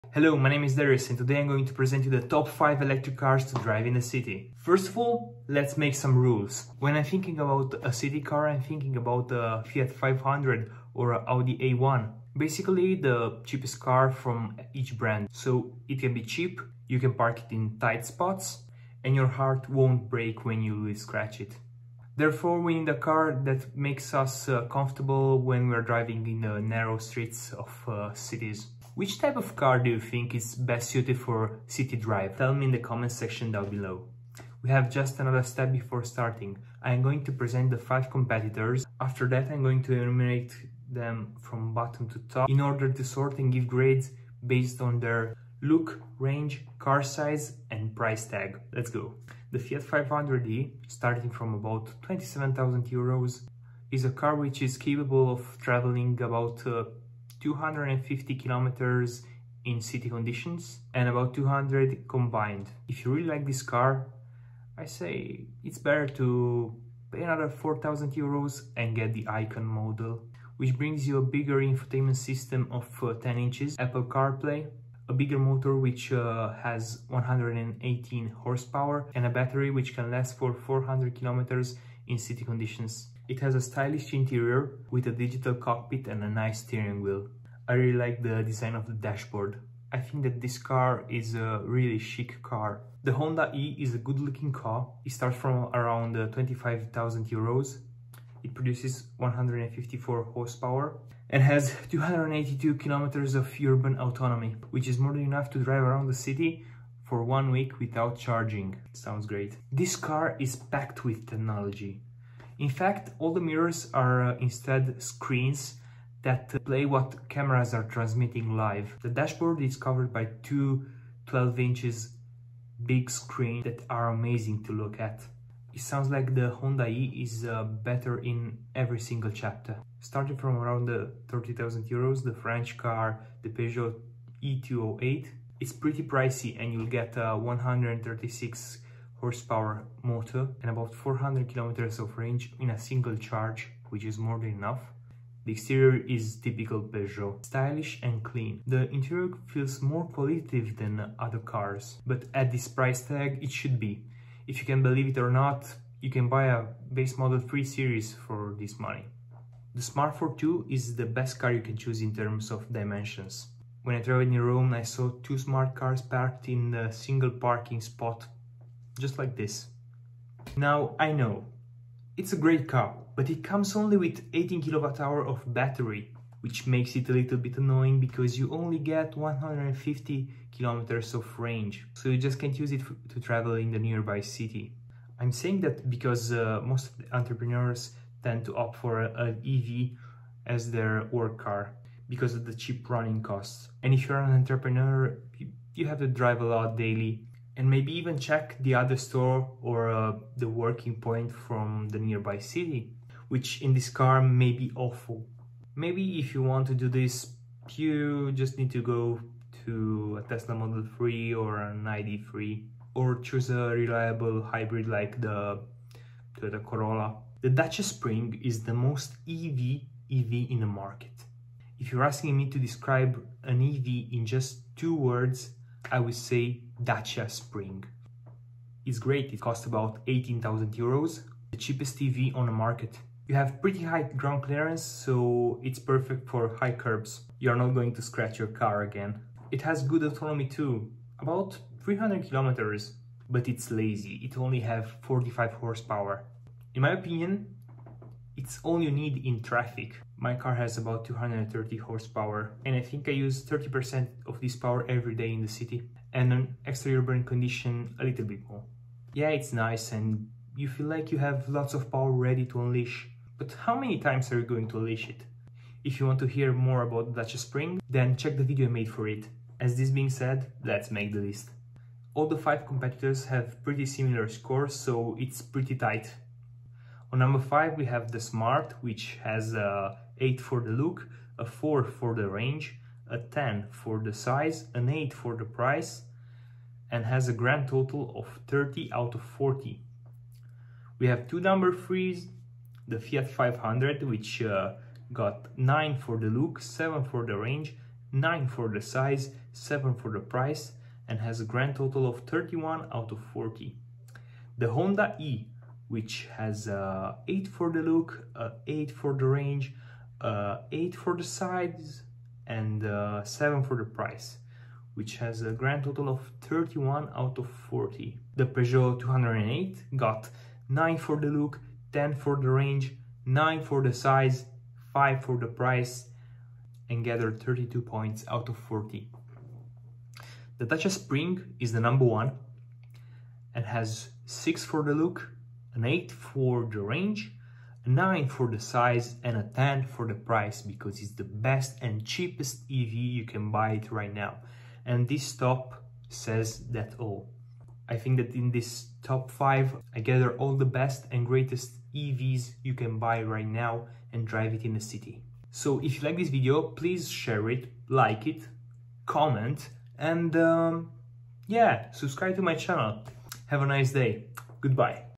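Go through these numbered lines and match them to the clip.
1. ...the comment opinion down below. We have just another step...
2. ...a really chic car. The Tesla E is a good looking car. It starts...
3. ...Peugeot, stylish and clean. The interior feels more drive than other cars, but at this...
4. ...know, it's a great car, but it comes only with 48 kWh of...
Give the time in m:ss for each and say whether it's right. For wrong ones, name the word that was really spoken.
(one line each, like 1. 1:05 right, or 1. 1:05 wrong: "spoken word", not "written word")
1. 0:32 wrong: "section", not "opinion"
2. 1:31 wrong: "Honda", not "Tesla"
3. 2:26 wrong: "qualitative", not "drive"
4. 2:51 wrong: "18", not "48".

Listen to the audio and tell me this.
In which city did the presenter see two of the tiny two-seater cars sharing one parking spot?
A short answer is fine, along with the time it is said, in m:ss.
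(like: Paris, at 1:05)
Rome, at 2:44.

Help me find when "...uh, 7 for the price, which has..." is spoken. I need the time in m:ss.
5:12.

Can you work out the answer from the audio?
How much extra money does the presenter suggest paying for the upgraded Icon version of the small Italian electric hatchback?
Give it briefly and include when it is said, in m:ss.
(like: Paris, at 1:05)
4000 euros, at 1:07.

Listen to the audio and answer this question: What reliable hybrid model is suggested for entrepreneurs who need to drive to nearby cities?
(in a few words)
Toyota Corolla.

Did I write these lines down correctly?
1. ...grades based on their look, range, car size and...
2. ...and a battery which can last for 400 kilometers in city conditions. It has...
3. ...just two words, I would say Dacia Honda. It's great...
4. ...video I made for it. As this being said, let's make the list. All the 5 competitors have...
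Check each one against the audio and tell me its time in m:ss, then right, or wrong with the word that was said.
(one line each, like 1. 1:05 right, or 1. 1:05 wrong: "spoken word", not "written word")
1. 0:43 right
2. 1:19 right
3. 3:44 wrong: "Spring", not "Honda"
4. 4:28 right.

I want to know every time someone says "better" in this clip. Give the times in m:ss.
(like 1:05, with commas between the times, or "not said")
1:05, 2:07.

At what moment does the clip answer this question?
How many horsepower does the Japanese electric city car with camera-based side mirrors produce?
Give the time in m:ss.
1:39.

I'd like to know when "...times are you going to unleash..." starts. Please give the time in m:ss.
4:23.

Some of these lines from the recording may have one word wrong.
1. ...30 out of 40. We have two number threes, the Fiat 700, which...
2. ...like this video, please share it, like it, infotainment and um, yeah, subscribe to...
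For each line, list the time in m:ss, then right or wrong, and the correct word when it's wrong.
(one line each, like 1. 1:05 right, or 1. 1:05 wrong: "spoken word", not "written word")
1. 4:48 wrong: "500", not "700"
2. 5:56 wrong: "comment", not "infotainment".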